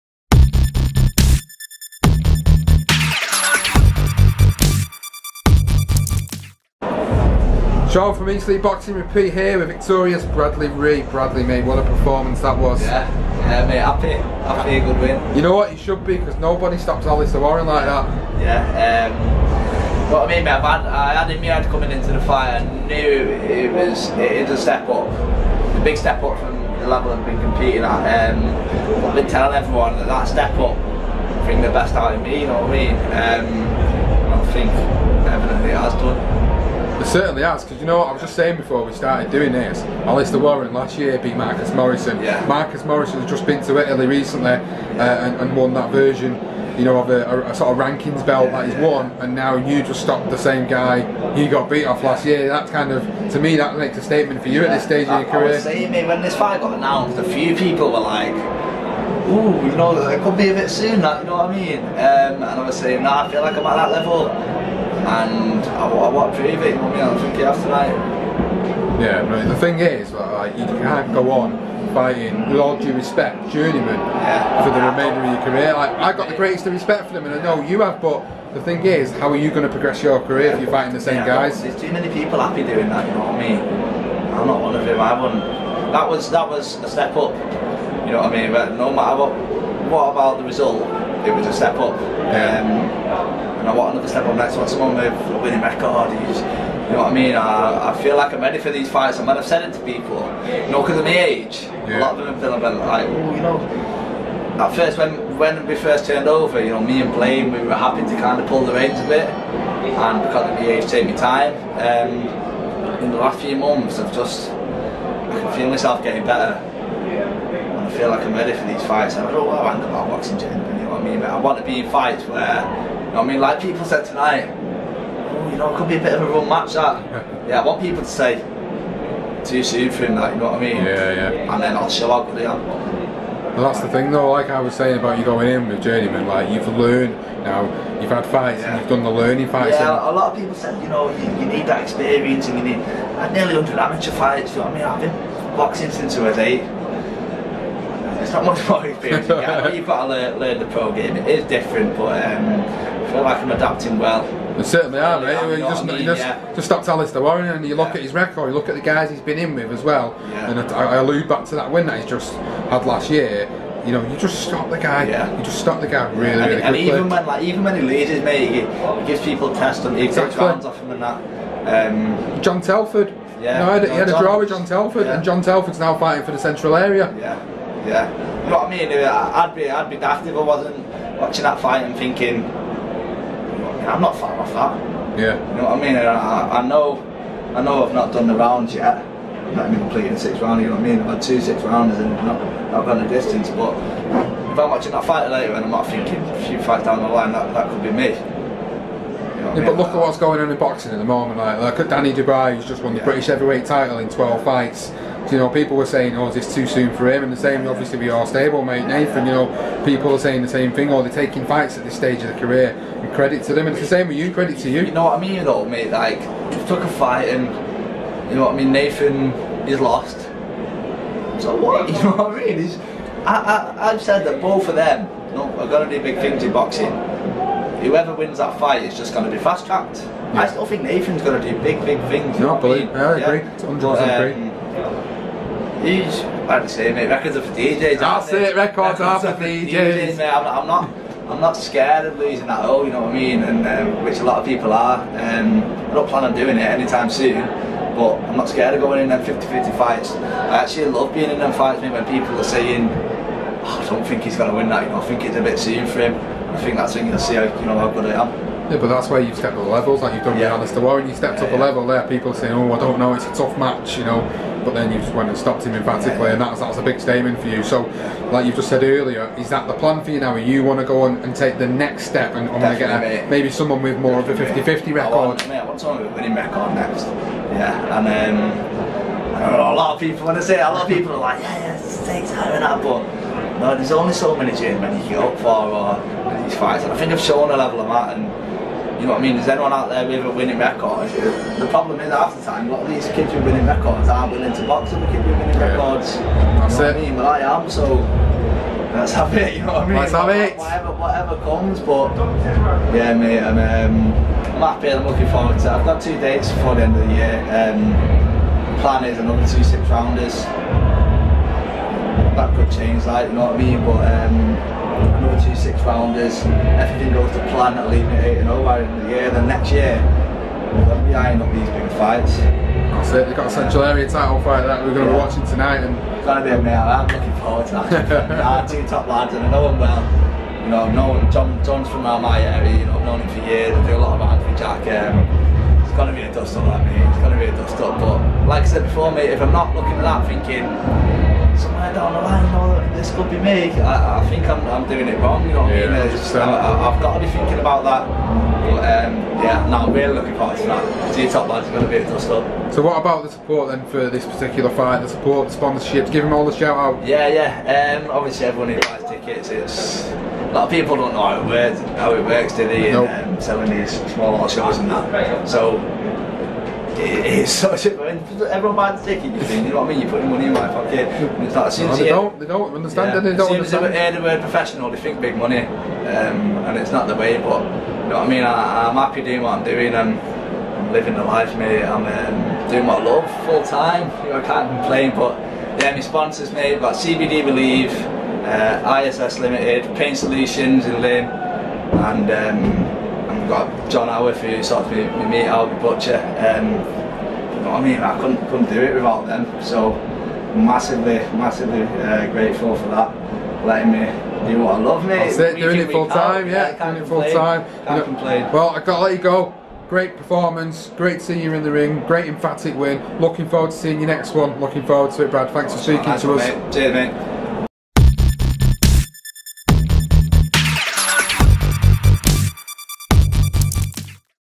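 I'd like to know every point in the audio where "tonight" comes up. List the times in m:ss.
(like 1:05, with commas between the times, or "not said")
2:04, 5:25.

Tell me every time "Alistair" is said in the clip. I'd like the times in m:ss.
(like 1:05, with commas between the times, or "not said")
0:17, 0:40, 2:36, 4:20.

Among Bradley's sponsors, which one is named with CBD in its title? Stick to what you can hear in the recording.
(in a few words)
CBD Believe.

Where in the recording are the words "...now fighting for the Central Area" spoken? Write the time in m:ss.
2:55.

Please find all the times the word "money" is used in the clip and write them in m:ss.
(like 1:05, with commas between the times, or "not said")
6:10, 6:15.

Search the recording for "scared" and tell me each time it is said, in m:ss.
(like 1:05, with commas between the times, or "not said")
4:01, 4:08.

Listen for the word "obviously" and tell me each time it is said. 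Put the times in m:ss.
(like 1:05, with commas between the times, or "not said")
3:27, 5:58.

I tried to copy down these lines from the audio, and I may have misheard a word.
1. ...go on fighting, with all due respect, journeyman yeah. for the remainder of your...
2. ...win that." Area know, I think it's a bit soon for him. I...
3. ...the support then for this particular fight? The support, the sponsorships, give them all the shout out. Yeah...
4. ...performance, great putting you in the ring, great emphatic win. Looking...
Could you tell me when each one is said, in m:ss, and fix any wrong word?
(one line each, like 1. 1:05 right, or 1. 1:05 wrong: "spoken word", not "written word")
1. 1:11 right
2. 4:14 wrong: "You", not "Area"
3. 5:53 right
4. 6:50 wrong: "seeing", not "putting".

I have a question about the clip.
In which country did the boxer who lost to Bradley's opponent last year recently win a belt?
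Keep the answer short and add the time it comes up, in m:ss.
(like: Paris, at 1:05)
Italy, at 0:43.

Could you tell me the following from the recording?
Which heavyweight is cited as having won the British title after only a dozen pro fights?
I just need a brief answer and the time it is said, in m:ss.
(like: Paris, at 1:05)
Danny Dubois, at 3:21.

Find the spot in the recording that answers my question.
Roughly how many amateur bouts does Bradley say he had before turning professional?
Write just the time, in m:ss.
2:23.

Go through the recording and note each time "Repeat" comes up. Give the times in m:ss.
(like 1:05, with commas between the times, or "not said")
0:08.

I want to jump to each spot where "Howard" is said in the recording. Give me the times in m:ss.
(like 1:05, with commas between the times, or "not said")
6:34.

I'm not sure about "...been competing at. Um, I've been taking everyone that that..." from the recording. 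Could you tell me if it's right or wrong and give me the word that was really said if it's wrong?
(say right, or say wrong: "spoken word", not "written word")
wrong: "telling", not "taking".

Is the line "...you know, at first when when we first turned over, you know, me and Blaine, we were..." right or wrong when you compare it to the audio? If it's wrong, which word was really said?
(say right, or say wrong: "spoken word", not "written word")
right.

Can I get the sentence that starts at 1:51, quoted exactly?
Um, in the last few months, I've just I can feel myself getting better.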